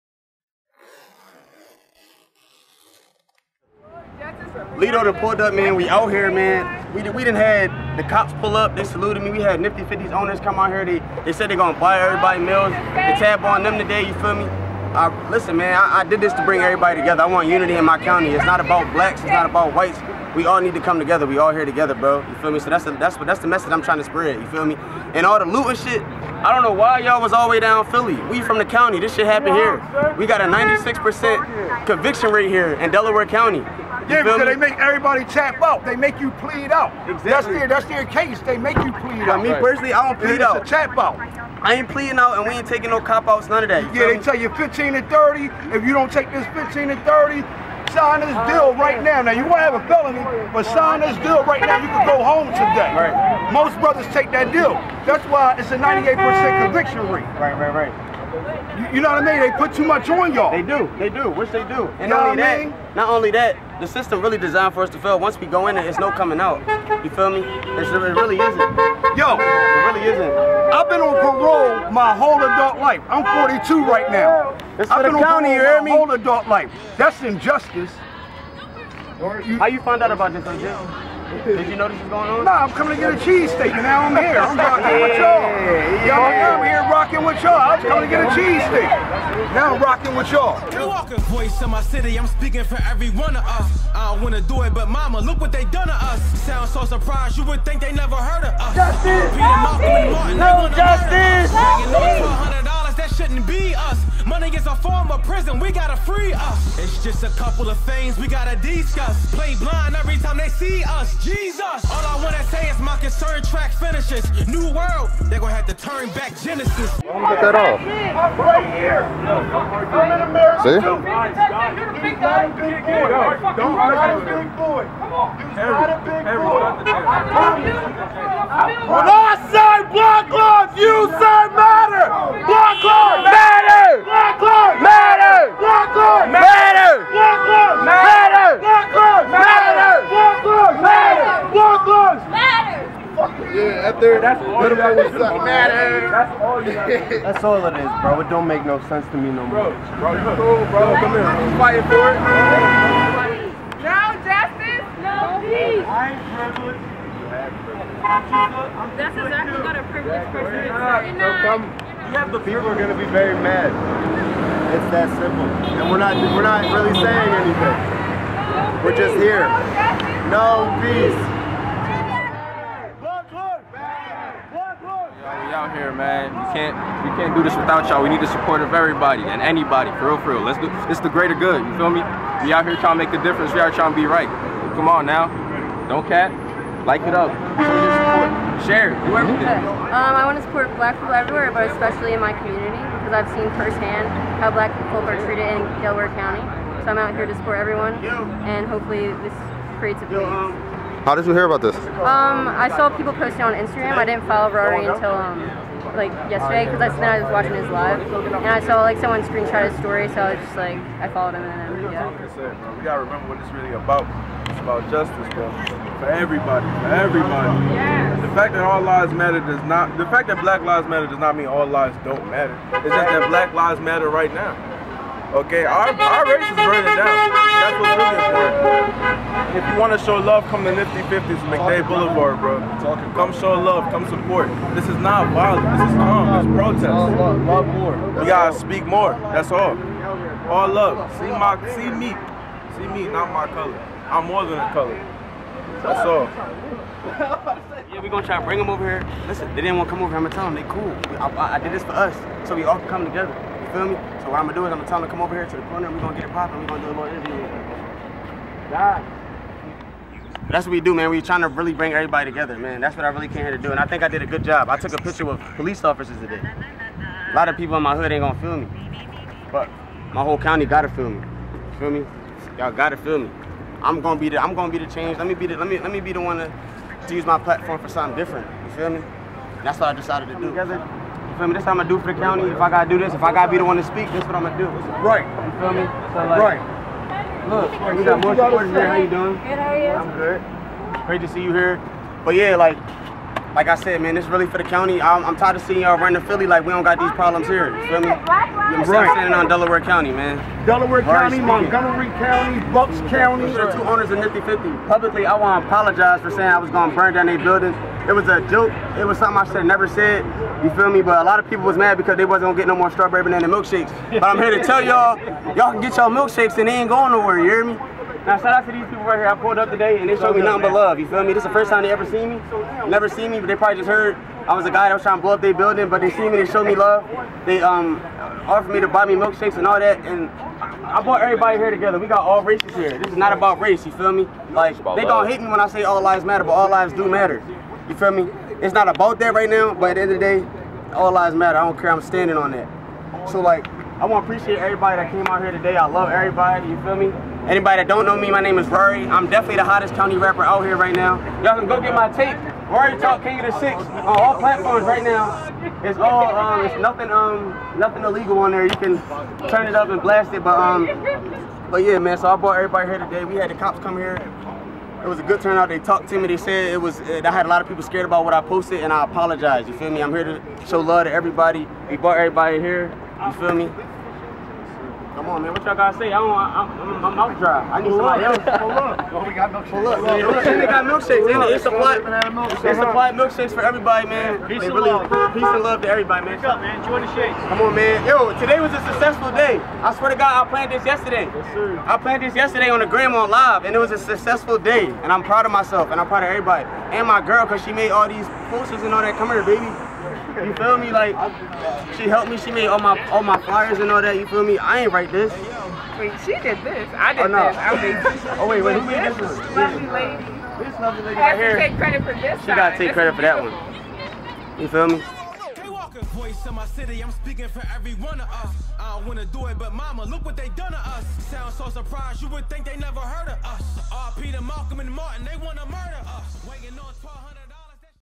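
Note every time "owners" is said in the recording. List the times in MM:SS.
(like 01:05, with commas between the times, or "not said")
00:10, 05:03.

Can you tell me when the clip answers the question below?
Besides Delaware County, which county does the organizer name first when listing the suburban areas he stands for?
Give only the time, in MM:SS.
05:01.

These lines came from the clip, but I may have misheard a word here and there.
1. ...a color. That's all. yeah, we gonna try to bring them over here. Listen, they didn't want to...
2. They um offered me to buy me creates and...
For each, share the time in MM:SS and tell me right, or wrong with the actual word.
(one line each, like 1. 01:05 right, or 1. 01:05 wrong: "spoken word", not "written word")
1. 04:04 right
2. 05:27 wrong: "milkshakes", not "creates".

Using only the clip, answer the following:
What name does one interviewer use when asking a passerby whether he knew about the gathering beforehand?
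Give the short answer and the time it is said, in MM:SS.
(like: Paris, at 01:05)
OJ, at 01:20.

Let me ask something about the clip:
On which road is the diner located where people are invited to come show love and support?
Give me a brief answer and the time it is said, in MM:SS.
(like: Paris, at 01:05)
MacDade Boulevard, at 03:51.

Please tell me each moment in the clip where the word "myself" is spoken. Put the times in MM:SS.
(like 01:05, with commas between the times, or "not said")
06:35.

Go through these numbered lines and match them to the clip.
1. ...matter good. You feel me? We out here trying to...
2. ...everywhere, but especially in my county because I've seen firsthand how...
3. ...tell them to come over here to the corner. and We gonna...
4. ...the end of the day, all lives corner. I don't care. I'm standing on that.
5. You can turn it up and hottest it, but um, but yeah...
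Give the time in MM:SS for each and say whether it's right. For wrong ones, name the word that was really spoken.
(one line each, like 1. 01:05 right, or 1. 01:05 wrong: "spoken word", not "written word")
1. 03:01 wrong: "greater", not "matter"
2. 03:11 wrong: "community", not "county"
3. 04:14 right
4. 05:39 wrong: "matter", not "corner"
5. 05:58 wrong: "blast", not "hottest".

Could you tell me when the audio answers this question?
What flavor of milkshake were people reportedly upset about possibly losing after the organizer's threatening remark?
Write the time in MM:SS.
05:12.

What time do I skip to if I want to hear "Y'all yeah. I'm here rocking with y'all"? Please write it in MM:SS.
01:26.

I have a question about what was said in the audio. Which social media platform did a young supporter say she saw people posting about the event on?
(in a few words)
Instagram.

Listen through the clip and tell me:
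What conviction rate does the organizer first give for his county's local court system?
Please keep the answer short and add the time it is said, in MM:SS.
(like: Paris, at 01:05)
96%, at 00:30.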